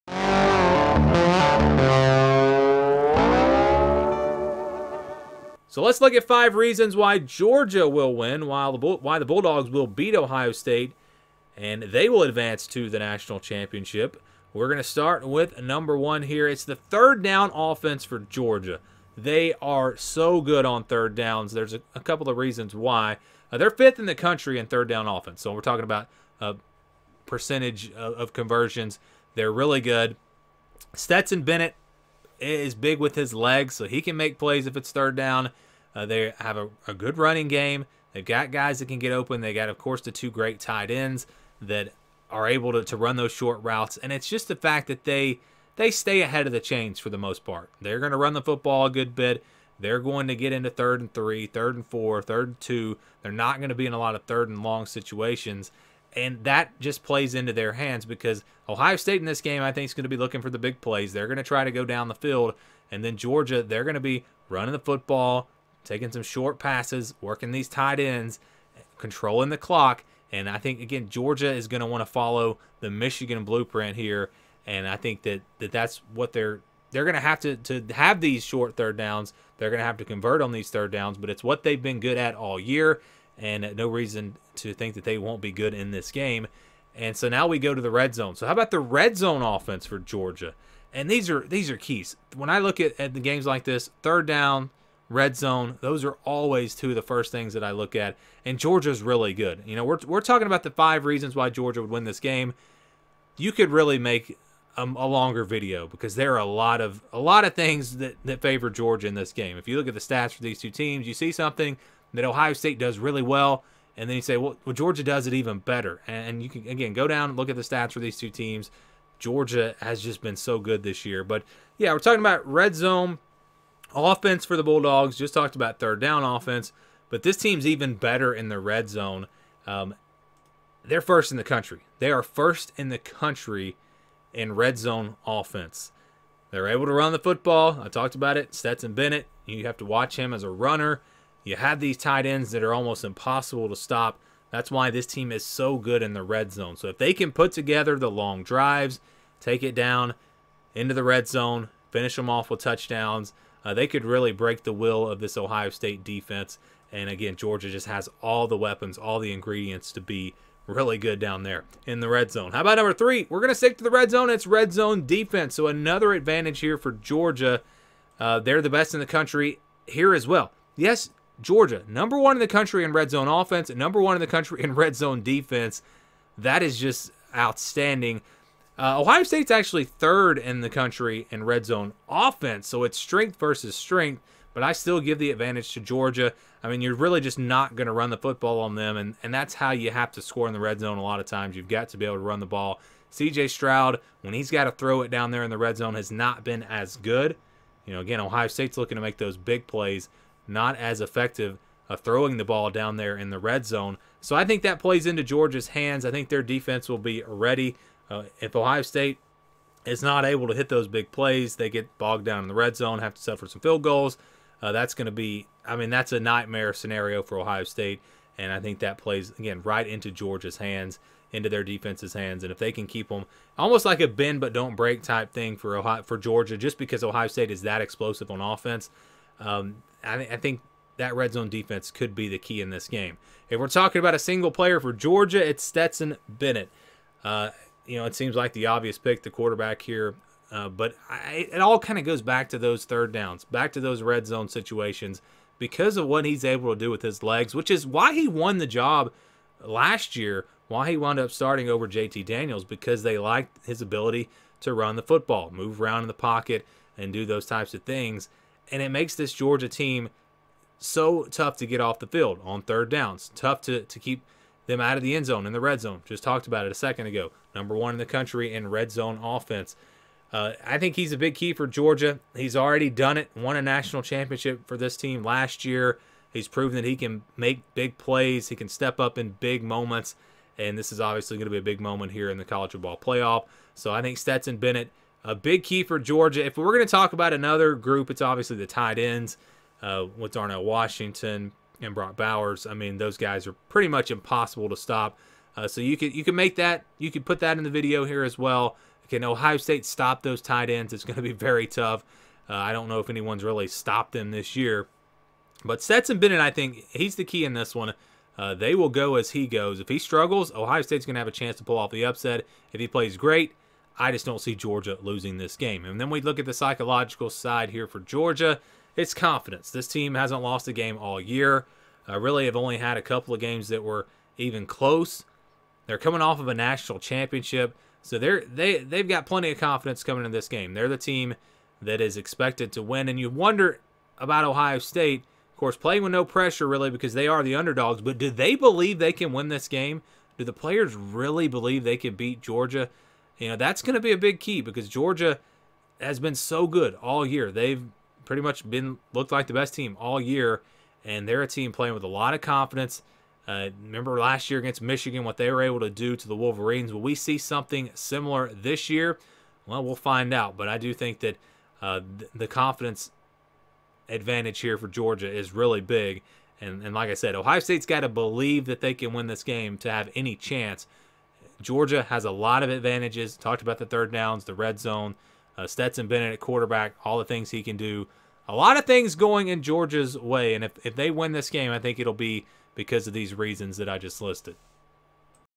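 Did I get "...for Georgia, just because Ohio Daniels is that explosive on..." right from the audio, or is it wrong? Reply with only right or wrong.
wrong.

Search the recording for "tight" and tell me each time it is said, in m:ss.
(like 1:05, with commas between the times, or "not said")
0:40, 1:07, 2:21, 4:48, 5:00.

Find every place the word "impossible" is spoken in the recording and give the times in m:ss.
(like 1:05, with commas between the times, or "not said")
2:23, 4:54.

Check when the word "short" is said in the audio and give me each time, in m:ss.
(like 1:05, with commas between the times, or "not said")
0:43, 1:06, 1:18.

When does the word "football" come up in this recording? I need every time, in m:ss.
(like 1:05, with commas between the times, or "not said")
0:48, 1:04, 2:17, 3:08, 4:15, 4:42.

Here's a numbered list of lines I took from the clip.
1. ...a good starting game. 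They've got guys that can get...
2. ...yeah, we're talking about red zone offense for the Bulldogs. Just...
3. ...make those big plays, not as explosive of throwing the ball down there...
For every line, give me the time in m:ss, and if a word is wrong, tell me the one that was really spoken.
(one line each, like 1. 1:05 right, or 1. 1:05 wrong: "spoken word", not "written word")
1. 0:36 wrong: "running", not "starting"
2. 2:01 right
3. 3:19 wrong: "effective", not "explosive".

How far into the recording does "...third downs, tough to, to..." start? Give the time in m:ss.
4:22.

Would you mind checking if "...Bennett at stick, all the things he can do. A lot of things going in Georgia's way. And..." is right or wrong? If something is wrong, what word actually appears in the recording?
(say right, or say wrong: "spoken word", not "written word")
wrong: "quarterback", not "stick".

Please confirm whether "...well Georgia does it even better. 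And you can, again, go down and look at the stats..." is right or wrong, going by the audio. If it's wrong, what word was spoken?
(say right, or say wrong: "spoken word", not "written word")
right.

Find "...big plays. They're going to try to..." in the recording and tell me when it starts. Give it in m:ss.
1:00.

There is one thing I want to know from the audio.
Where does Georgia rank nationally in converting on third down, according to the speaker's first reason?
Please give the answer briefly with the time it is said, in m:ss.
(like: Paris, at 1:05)
5th, at 0:23.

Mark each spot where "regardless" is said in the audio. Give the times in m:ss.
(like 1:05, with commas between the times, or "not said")
not said.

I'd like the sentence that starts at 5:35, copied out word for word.
Of course, playing with no pressure really because they are the underdogs.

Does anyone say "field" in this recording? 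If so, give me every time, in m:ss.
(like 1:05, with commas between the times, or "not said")
1:02, 3:33, 4:22.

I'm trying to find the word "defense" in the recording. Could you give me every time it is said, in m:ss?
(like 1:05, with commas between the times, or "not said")
2:36, 2:45, 2:55, 3:26, 3:41, 3:51.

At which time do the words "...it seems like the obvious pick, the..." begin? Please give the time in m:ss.
3:58.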